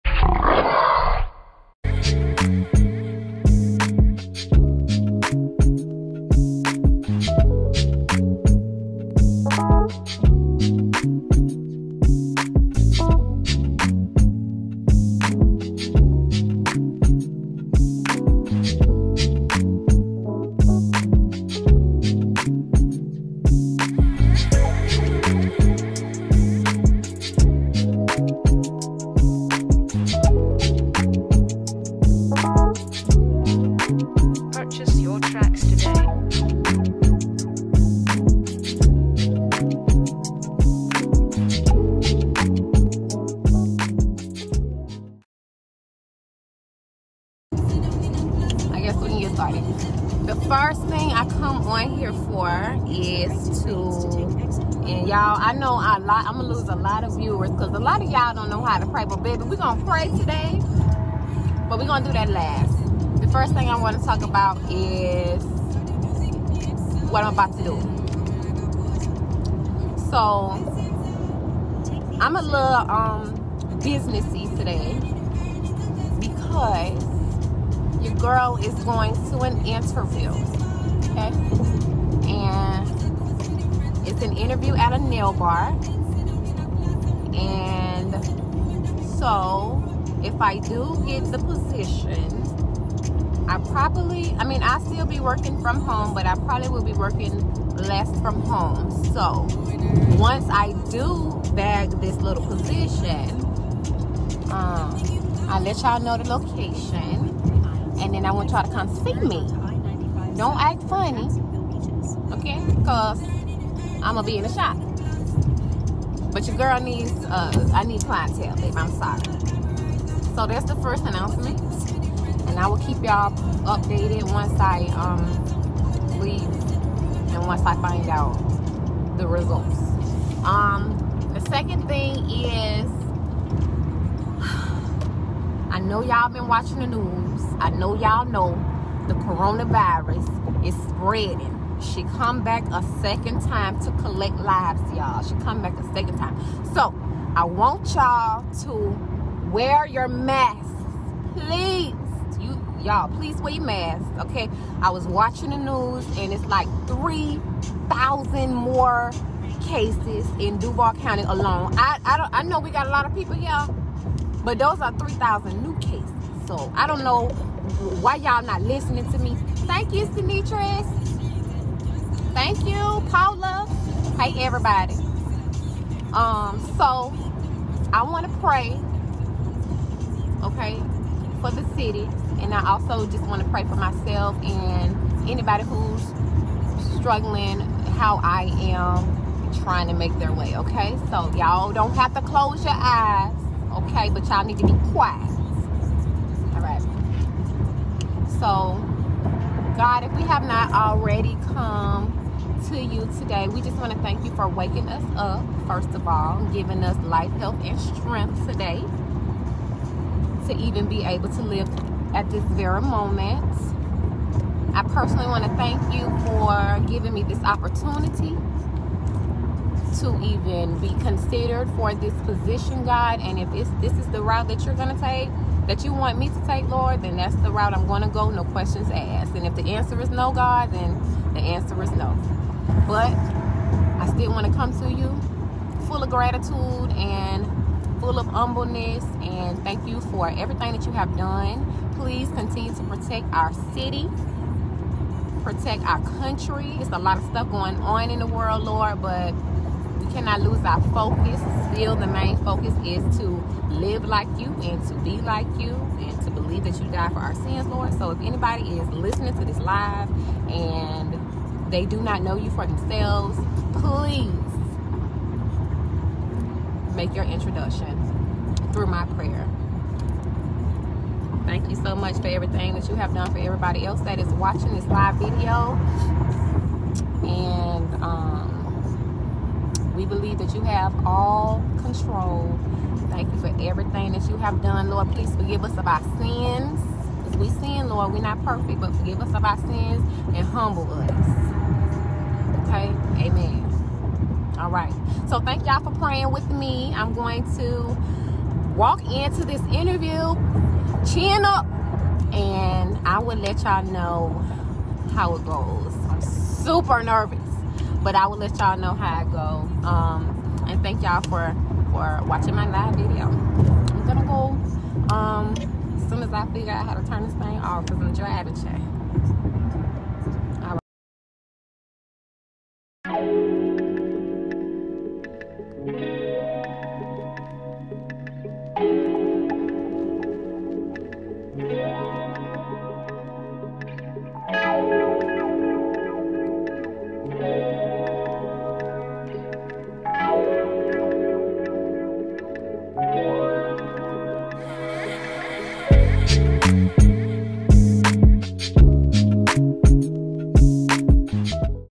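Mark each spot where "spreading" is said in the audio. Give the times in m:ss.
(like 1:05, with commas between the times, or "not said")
2:20.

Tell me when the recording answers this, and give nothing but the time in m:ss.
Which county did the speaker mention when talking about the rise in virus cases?
2:40.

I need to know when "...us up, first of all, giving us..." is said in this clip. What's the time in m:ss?
3:24.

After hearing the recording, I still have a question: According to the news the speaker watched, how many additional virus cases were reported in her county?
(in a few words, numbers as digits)
3,000.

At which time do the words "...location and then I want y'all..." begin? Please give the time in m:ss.
1:46.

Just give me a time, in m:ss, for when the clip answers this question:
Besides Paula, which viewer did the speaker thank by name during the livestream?
2:50.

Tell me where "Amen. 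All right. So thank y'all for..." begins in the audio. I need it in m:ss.
4:53.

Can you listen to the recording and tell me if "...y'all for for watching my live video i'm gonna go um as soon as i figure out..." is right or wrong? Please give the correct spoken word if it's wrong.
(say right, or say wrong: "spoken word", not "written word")
right.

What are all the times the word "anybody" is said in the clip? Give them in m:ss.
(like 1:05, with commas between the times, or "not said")
3:05, 4:18.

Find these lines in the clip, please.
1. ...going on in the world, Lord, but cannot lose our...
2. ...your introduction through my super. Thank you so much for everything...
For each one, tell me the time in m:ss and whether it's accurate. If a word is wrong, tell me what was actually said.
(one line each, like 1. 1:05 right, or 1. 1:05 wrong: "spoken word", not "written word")
1. 4:07 right
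2. 4:27 wrong: "prayer", not "super".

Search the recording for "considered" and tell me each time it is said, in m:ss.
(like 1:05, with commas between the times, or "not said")
3:41.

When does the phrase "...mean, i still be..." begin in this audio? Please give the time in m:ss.
1:34.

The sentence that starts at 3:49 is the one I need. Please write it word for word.
And if the answer is no, God, then the answer is no.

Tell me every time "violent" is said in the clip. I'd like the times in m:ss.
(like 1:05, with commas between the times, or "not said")
not said.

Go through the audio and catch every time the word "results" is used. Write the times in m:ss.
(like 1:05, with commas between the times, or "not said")
2:09.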